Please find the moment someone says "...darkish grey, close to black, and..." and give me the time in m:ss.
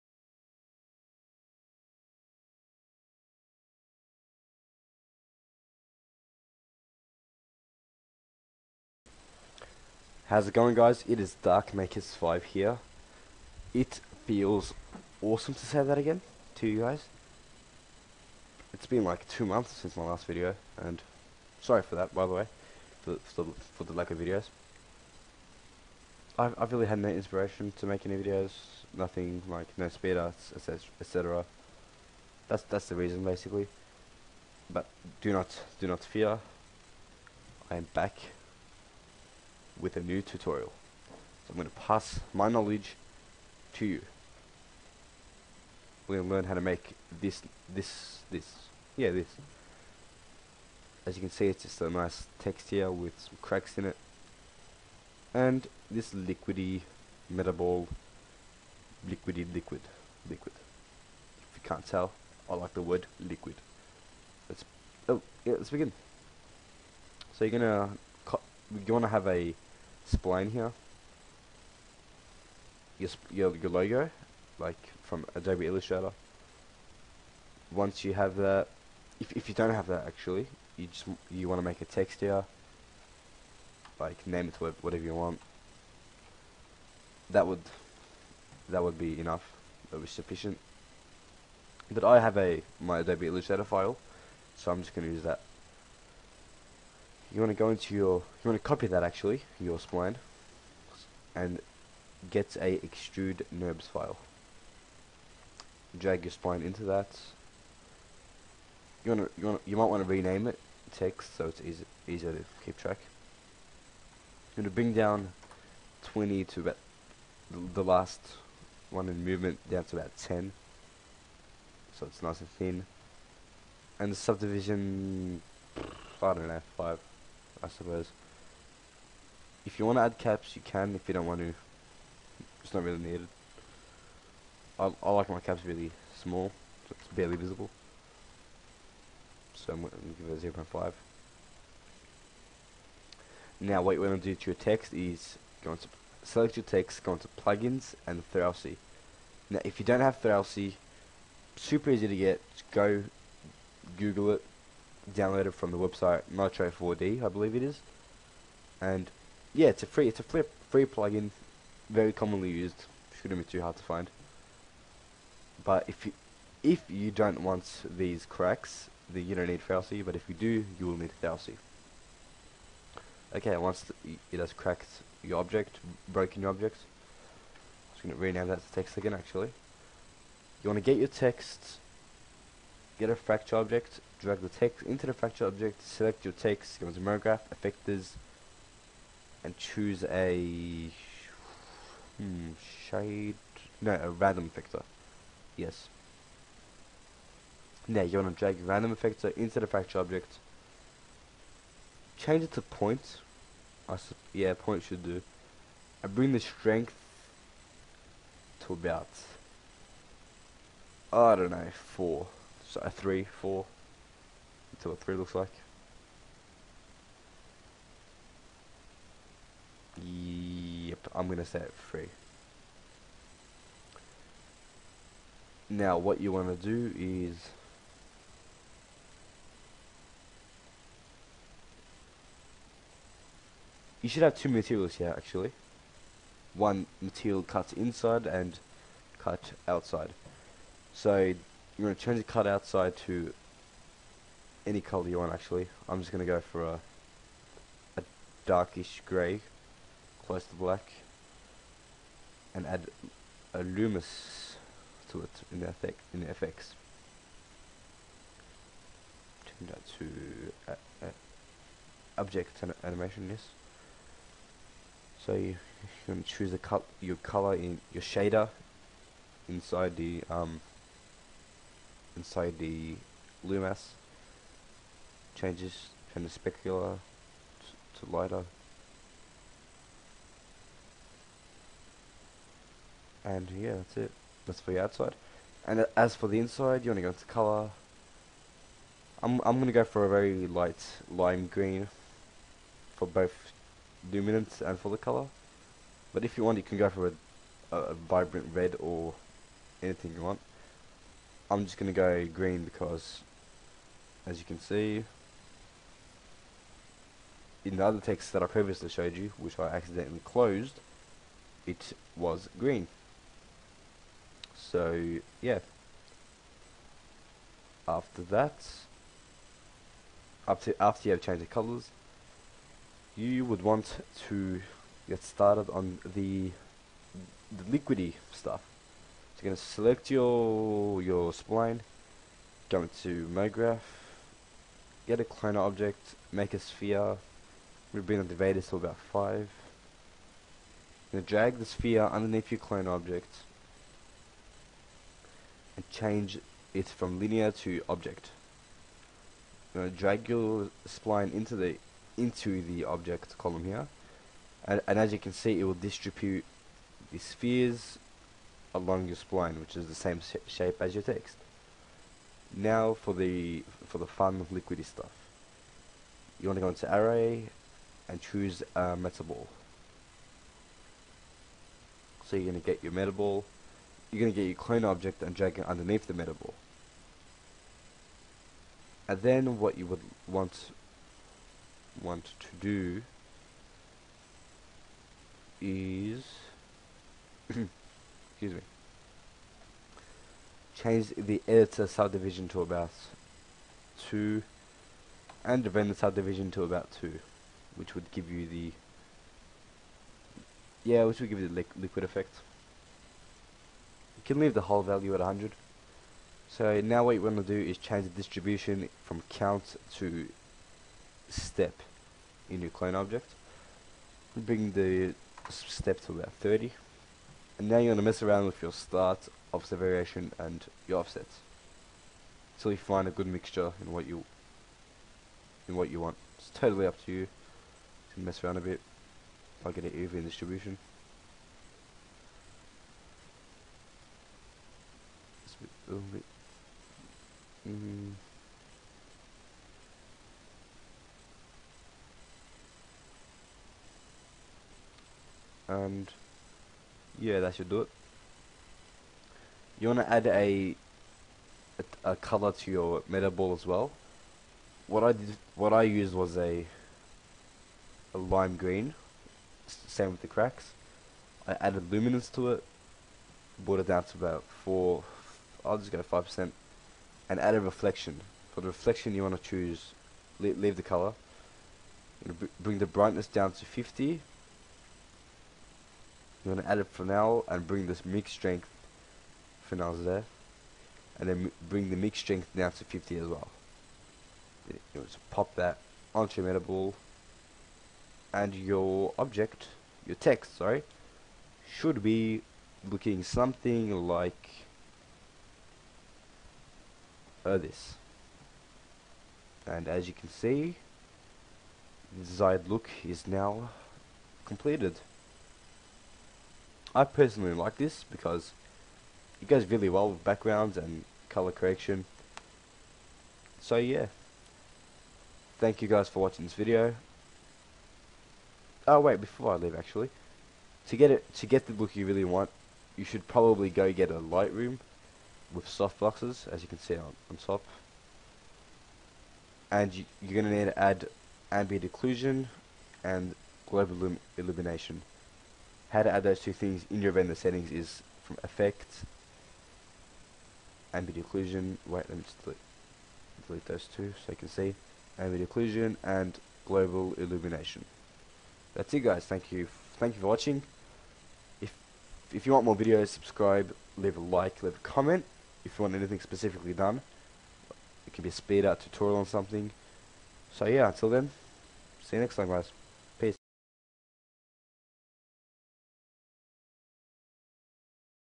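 4:08.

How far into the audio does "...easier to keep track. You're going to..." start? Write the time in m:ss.
1:52.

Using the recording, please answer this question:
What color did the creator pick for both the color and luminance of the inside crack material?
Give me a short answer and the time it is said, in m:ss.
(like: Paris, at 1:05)
light lime green, at 4:50.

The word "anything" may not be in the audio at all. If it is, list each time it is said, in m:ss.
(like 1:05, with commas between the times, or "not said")
4:59, 9:15.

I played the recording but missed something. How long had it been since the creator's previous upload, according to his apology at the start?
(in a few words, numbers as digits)
2 months.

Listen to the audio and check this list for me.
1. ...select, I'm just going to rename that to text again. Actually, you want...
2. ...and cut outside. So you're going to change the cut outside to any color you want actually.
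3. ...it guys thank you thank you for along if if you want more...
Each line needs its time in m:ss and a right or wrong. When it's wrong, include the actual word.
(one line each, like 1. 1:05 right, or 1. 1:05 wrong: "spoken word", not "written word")
1. 2:56 wrong: "object", not "select"
2. 3:58 right
3. 9:08 wrong: "watching", not "along".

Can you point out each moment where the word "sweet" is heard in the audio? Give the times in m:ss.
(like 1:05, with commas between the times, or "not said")
not said.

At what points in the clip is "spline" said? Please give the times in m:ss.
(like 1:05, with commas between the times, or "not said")
1:10, 1:39, 1:46, 5:31, 5:50, 5:59.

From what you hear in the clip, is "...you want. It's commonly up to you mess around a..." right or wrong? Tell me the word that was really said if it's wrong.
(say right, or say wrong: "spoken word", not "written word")
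wrong: "totally", not "commonly".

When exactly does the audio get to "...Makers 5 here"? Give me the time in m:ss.
0:11.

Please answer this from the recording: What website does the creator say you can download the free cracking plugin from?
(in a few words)
Nitro4D.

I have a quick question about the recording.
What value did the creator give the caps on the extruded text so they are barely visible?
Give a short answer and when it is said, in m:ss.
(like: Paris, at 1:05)
0.5, at 2:20.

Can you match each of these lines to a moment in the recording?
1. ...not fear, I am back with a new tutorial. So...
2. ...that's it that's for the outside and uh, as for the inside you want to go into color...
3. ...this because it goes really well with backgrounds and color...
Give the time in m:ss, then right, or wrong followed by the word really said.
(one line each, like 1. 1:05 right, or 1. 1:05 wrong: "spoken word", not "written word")
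1. 0:35 right
2. 4:43 right
3. 8:27 right.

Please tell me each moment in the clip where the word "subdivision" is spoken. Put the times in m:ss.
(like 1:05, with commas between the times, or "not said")
2:04, 6:31, 6:35.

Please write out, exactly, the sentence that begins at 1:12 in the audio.
Your, your, your logo, like from Adobe Illustrator.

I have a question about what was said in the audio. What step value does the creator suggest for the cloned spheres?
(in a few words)
30.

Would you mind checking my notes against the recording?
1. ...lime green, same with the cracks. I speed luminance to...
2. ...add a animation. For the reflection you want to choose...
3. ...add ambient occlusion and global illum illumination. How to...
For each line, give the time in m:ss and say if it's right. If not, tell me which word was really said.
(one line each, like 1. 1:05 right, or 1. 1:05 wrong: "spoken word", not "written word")
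1. 7:38 wrong: "added", not "speed"
2. 7:47 wrong: "reflection", not "animation"
3. 8:50 right.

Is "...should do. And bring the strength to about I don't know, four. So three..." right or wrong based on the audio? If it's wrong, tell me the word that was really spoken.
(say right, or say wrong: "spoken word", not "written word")
right.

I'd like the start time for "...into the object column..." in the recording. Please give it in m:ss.
5:52.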